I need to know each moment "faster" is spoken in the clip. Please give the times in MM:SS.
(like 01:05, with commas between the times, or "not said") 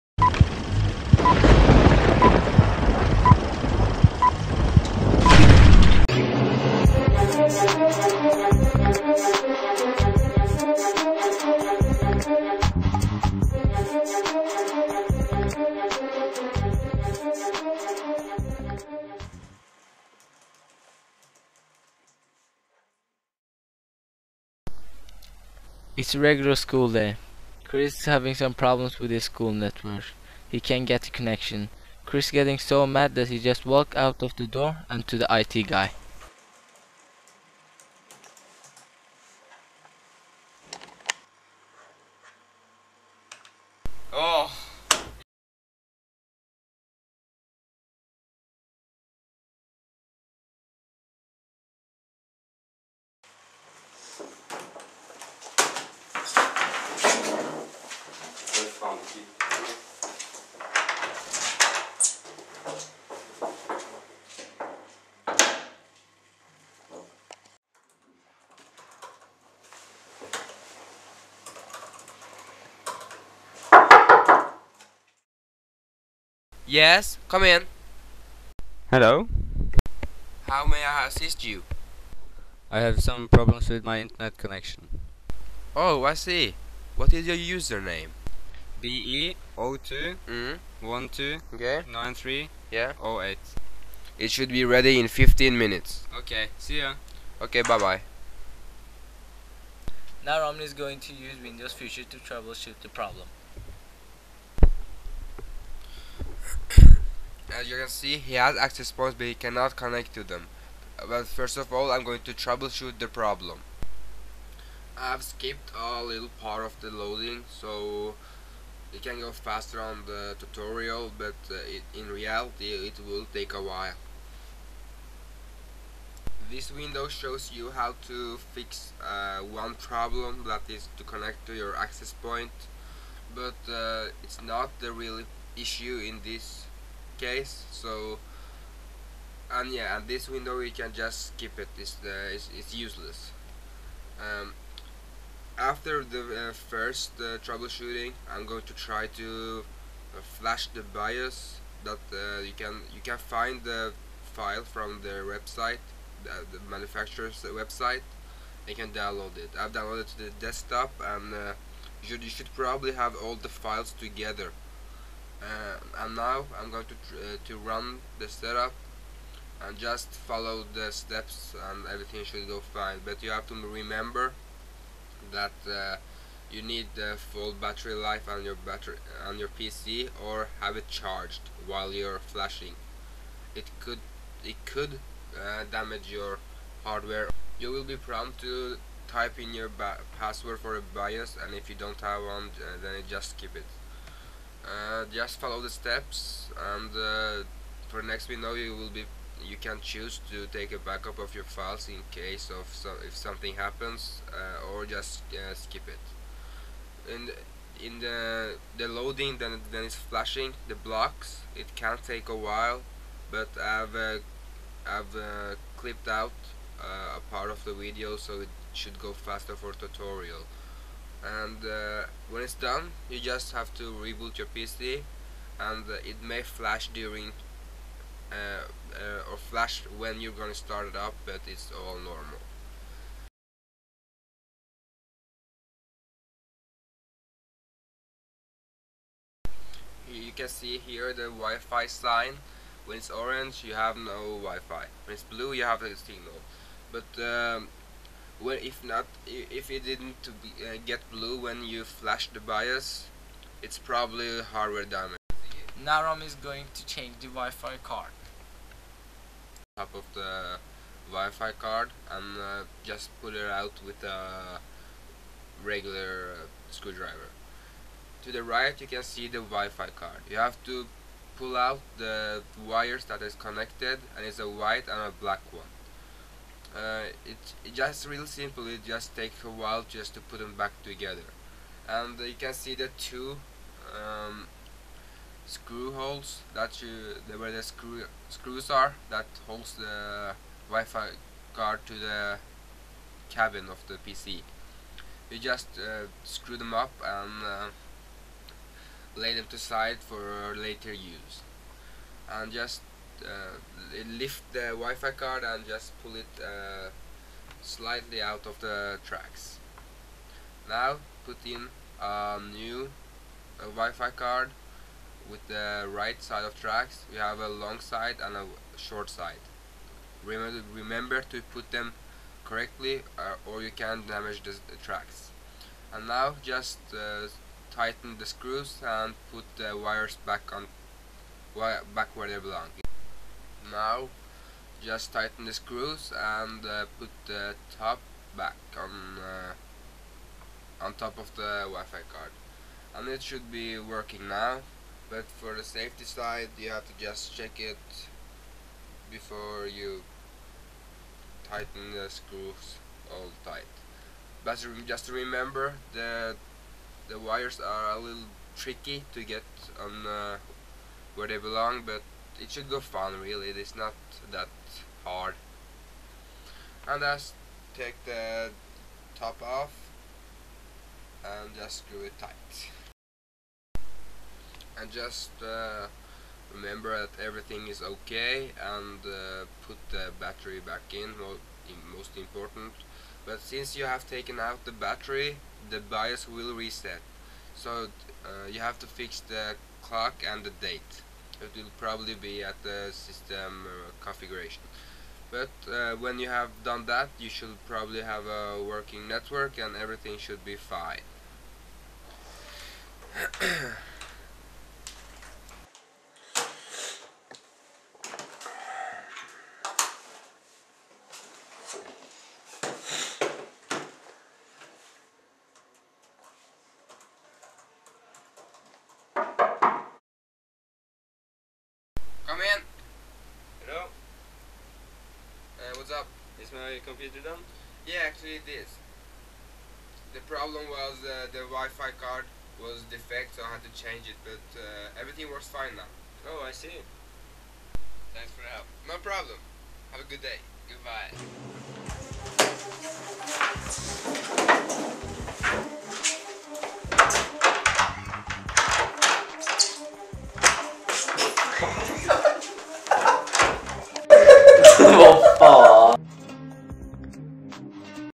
01:59, 03:39.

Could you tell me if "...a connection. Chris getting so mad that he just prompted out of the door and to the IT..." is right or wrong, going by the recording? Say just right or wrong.
wrong.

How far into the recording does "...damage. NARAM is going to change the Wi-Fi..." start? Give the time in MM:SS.
04:14.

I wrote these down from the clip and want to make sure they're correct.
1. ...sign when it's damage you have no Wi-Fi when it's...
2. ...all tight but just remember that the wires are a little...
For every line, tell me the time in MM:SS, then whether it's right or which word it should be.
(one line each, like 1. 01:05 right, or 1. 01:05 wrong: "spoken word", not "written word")
1. 04:01 wrong: "orange", not "damage"
2. 05:53 right.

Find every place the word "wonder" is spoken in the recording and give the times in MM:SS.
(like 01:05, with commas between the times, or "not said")
not said.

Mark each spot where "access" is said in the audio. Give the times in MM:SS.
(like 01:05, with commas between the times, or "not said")
01:48, 02:11.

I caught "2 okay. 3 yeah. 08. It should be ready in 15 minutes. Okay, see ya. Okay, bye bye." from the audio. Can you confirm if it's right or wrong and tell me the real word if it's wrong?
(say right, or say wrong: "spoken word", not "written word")
right.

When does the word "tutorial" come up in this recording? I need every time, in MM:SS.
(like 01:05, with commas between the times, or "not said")
02:00, 03:39.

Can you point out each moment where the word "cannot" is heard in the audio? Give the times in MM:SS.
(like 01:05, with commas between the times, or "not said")
01:49.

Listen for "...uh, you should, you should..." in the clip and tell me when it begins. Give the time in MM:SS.
02:41.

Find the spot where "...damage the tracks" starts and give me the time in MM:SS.
05:24.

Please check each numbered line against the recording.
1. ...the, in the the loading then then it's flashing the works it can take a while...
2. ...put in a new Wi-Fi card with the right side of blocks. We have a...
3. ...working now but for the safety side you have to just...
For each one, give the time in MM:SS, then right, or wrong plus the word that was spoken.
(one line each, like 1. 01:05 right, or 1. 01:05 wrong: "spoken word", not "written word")
1. 03:27 wrong: "blocks", not "works"
2. 05:11 wrong: "tracks", not "blocks"
3. 05:43 right.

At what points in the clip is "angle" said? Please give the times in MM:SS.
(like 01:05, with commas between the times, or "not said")
not said.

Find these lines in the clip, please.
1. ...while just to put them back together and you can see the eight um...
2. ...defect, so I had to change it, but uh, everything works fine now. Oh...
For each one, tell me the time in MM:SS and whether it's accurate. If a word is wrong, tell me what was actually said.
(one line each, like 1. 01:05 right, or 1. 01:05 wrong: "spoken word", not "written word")
1. 04:39 wrong: "two", not "eight"
2. 07:12 right.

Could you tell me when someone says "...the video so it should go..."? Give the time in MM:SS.
03:37.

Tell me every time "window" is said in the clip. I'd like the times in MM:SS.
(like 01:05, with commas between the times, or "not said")
01:41, 02:06, 02:20.